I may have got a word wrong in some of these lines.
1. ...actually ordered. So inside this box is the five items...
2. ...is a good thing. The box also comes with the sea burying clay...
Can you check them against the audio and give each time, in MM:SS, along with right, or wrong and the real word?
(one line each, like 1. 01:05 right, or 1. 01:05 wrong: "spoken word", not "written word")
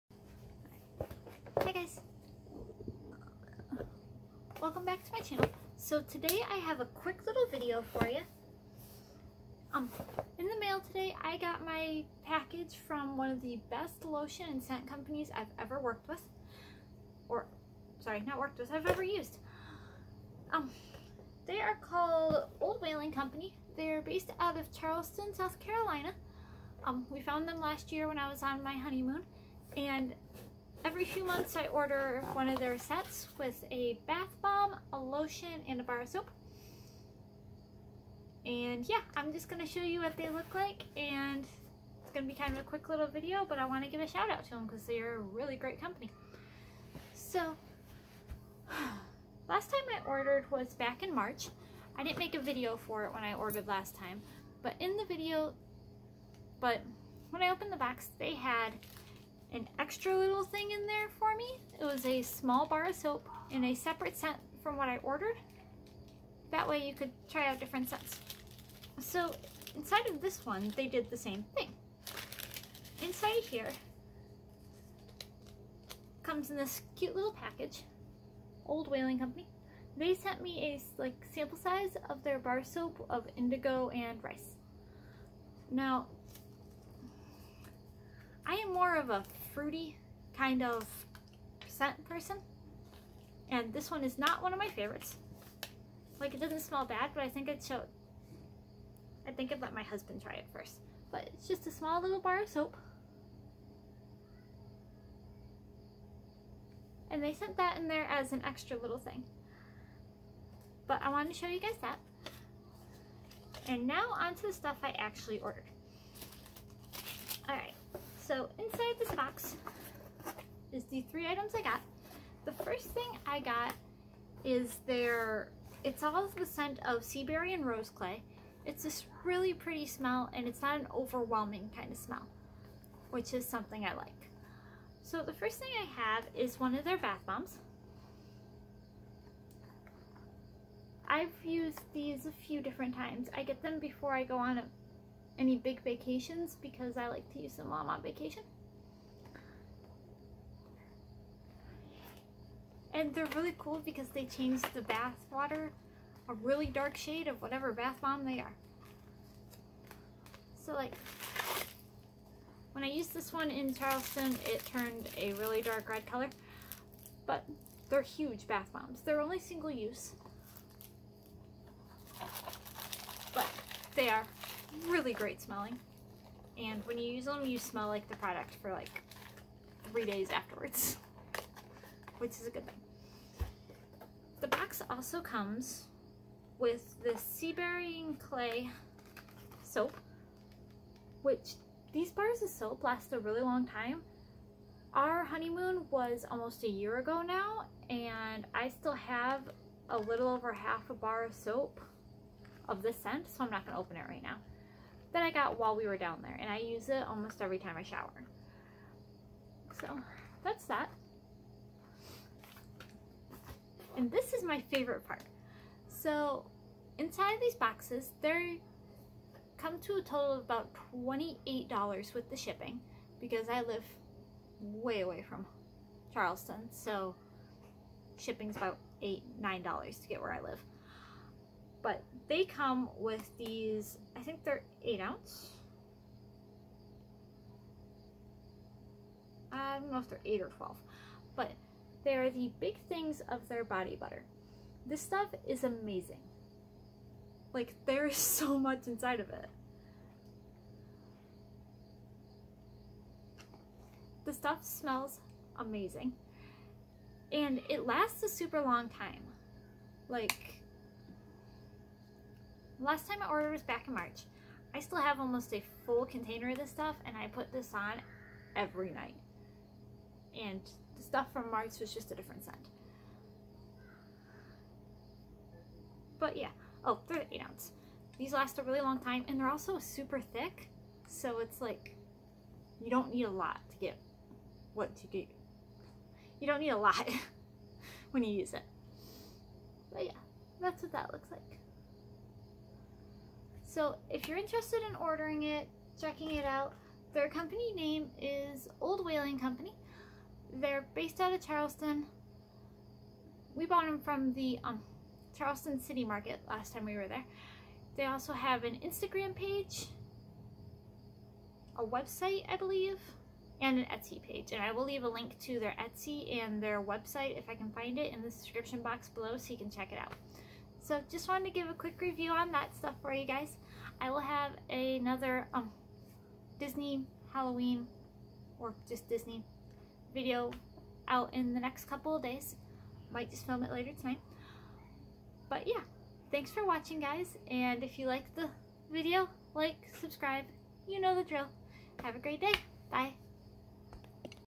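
1. 01:54 wrong: "three", not "five"
2. 03:02 right.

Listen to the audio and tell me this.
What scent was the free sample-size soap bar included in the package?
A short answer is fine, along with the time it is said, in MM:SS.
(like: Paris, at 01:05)
Indigo and rice, at 01:23.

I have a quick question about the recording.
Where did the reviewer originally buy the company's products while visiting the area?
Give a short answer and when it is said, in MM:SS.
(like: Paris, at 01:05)
Charleston City Market, at 05:05.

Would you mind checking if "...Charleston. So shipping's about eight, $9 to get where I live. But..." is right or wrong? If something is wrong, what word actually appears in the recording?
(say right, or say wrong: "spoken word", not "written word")
right.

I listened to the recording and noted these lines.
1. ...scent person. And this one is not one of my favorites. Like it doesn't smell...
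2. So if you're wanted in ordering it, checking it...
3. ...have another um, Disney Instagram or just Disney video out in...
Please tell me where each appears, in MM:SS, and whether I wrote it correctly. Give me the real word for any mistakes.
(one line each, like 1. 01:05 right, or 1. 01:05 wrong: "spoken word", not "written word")
1. 01:31 right
2. 04:53 wrong: "interested", not "wanted"
3. 05:24 wrong: "Halloween", not "Instagram".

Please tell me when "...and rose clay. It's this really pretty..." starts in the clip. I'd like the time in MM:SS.
02:07.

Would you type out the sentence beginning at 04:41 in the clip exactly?
So it's like, you don't need a lot to get what to get.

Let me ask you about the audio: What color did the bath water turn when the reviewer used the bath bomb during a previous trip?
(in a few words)
Dark red.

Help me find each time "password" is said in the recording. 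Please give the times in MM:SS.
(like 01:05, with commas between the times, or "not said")
not said.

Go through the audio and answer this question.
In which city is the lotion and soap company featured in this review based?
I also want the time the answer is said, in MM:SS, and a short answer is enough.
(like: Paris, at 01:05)
Charleston, South Carolina, at 00:24.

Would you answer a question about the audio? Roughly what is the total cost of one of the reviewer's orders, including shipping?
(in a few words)
$28.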